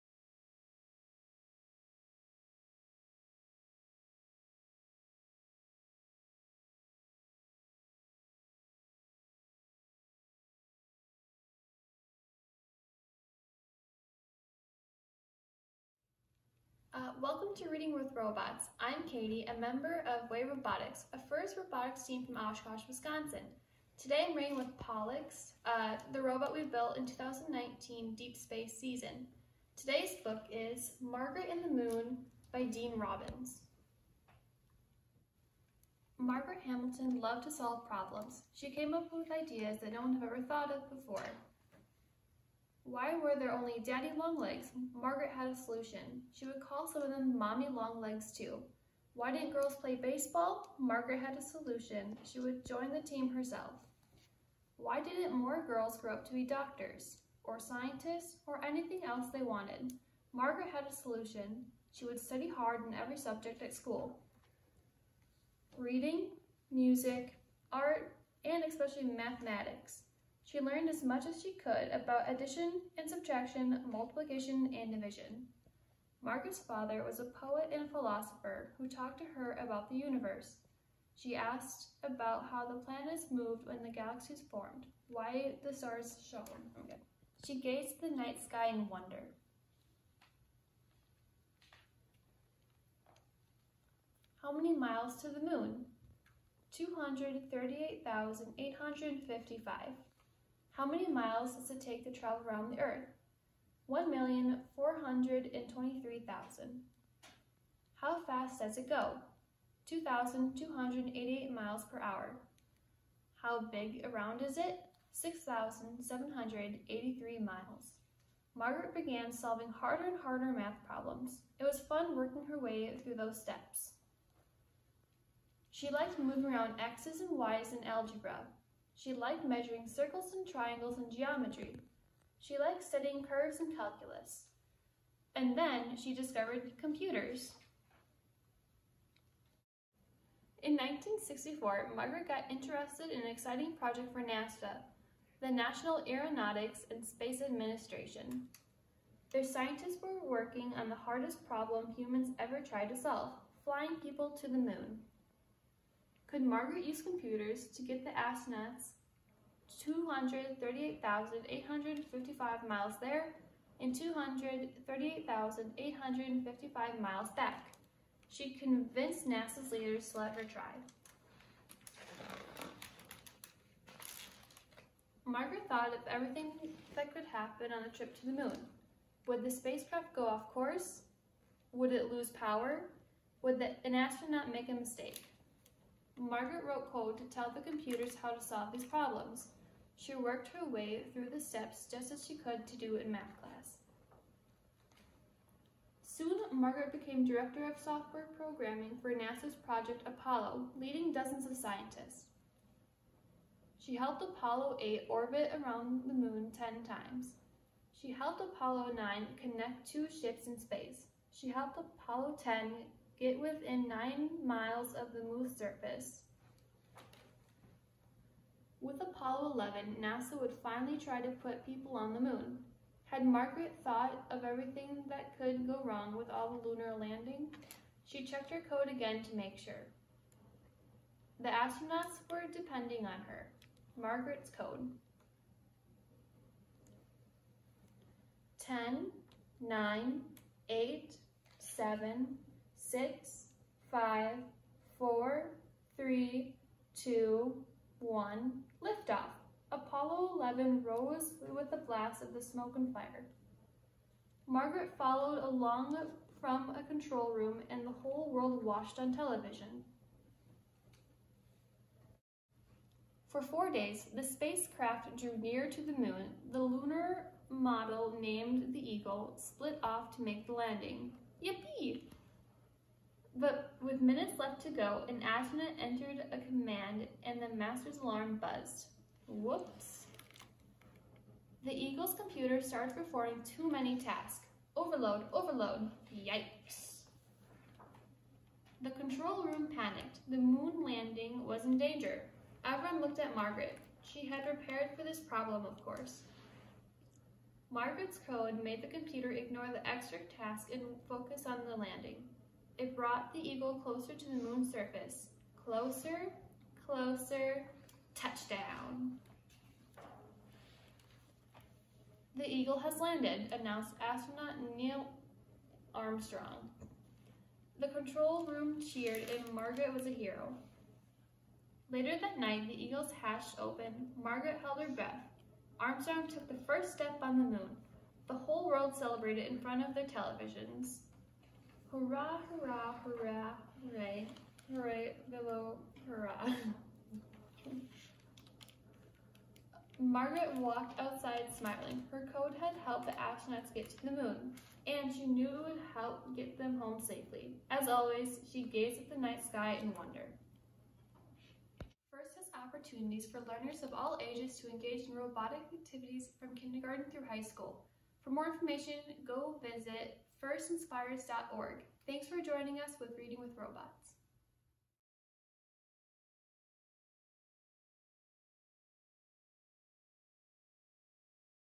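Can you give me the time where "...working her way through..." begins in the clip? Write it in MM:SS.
02:02.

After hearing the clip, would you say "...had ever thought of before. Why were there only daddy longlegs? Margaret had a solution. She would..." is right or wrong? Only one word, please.
right.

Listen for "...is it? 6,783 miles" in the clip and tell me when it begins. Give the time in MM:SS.
01:54.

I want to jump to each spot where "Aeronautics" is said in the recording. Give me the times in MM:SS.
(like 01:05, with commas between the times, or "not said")
02:26.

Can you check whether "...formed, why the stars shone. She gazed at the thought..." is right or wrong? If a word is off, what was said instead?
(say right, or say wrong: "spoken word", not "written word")
wrong: "night", not "thought".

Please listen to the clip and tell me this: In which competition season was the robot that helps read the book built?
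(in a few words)
2019 Deep Space.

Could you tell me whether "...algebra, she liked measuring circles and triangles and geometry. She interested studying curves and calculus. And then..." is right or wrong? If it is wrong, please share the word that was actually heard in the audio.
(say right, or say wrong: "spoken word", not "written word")
wrong: "liked", not "interested".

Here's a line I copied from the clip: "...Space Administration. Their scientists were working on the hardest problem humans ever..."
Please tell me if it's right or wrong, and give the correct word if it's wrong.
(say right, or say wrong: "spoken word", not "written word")
right.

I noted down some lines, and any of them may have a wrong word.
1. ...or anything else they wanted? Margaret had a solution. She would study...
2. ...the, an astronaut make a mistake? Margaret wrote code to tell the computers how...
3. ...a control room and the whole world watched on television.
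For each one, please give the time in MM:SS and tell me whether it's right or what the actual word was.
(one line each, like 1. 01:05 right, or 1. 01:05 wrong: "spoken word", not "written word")
1. 00:58 right
2. 03:03 right
3. 04:16 right.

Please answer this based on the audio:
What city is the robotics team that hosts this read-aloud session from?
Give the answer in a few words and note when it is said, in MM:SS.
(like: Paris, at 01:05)
Oshkosh, Wisconsin, at 00:22.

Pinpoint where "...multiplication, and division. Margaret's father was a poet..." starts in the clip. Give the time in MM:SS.
01:13.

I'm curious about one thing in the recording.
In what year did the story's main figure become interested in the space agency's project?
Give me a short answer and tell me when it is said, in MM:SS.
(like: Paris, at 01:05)
1964, at 02:20.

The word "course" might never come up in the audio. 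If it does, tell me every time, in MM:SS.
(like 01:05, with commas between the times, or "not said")
03:00, 04:55.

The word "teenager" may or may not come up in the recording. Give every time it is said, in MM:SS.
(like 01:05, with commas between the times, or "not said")
not said.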